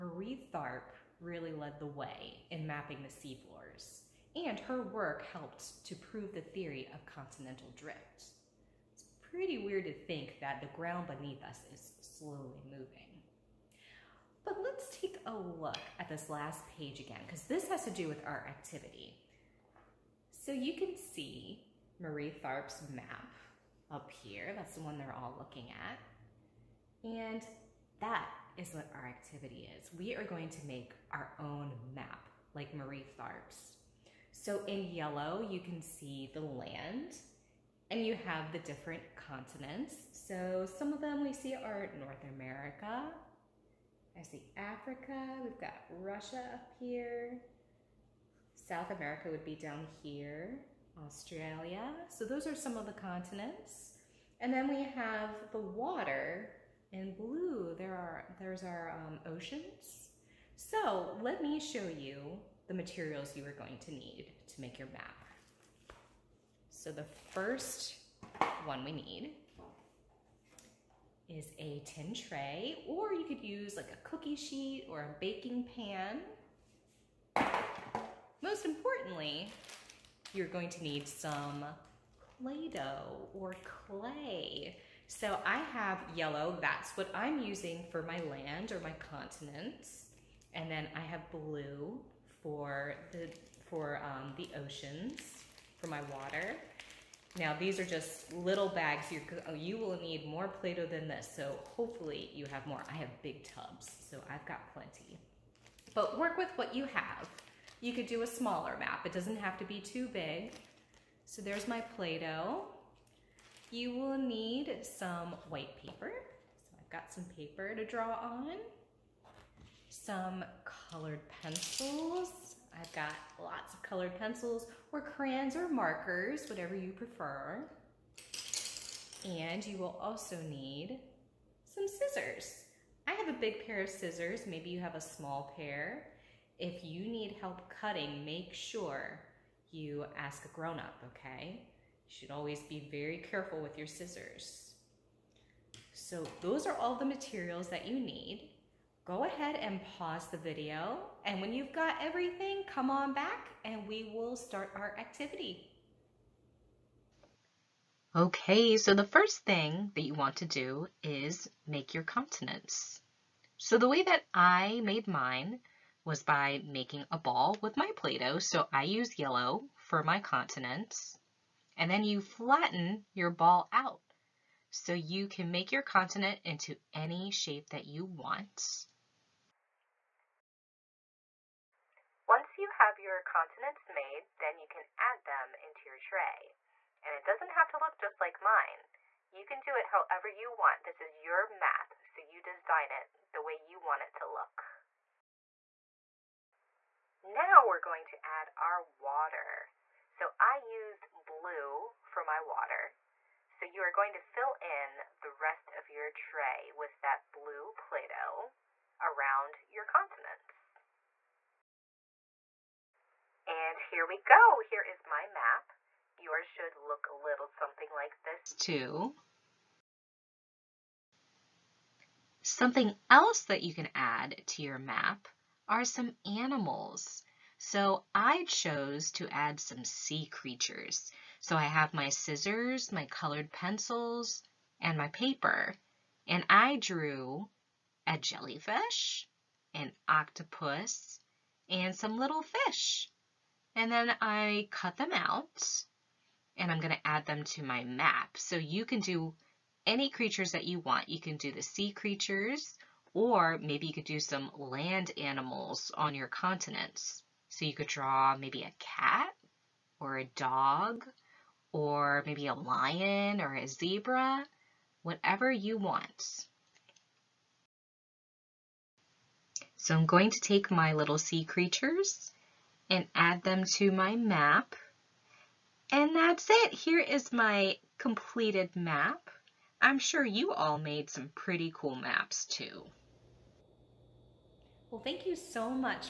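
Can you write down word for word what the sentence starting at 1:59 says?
Some colored pencils I've got lots of colored pencils or crayons or markers, whatever you prefer.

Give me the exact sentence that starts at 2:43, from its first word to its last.
So the way that I made mine was by making a ball with my Play-Doh.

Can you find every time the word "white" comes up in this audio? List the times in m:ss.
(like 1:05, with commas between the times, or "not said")
1:55.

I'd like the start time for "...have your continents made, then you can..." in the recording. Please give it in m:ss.
3:02.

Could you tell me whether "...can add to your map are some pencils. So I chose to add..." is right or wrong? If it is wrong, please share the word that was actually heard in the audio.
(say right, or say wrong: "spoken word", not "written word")
wrong: "animals", not "pencils".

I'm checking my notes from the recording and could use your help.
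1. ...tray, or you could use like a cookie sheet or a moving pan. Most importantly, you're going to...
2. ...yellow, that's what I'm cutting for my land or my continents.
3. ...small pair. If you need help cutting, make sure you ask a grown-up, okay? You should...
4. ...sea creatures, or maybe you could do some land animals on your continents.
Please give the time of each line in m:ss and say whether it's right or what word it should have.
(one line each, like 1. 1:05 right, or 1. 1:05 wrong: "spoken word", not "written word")
1. 1:12 wrong: "baking", not "moving"
2. 1:26 wrong: "using", not "cutting"
3. 2:14 right
4. 4:11 right.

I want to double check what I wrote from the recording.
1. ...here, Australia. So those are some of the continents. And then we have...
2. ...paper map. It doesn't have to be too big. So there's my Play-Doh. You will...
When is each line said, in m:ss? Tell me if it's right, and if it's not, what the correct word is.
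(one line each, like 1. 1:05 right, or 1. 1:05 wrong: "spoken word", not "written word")
1. 0:50 right
2. 1:48 wrong: "smaller", not "paper".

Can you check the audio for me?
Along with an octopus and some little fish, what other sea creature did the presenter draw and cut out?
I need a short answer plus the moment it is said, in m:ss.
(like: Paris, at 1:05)
Jellyfish, at 3:58.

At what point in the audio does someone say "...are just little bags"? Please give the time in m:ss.
1:37.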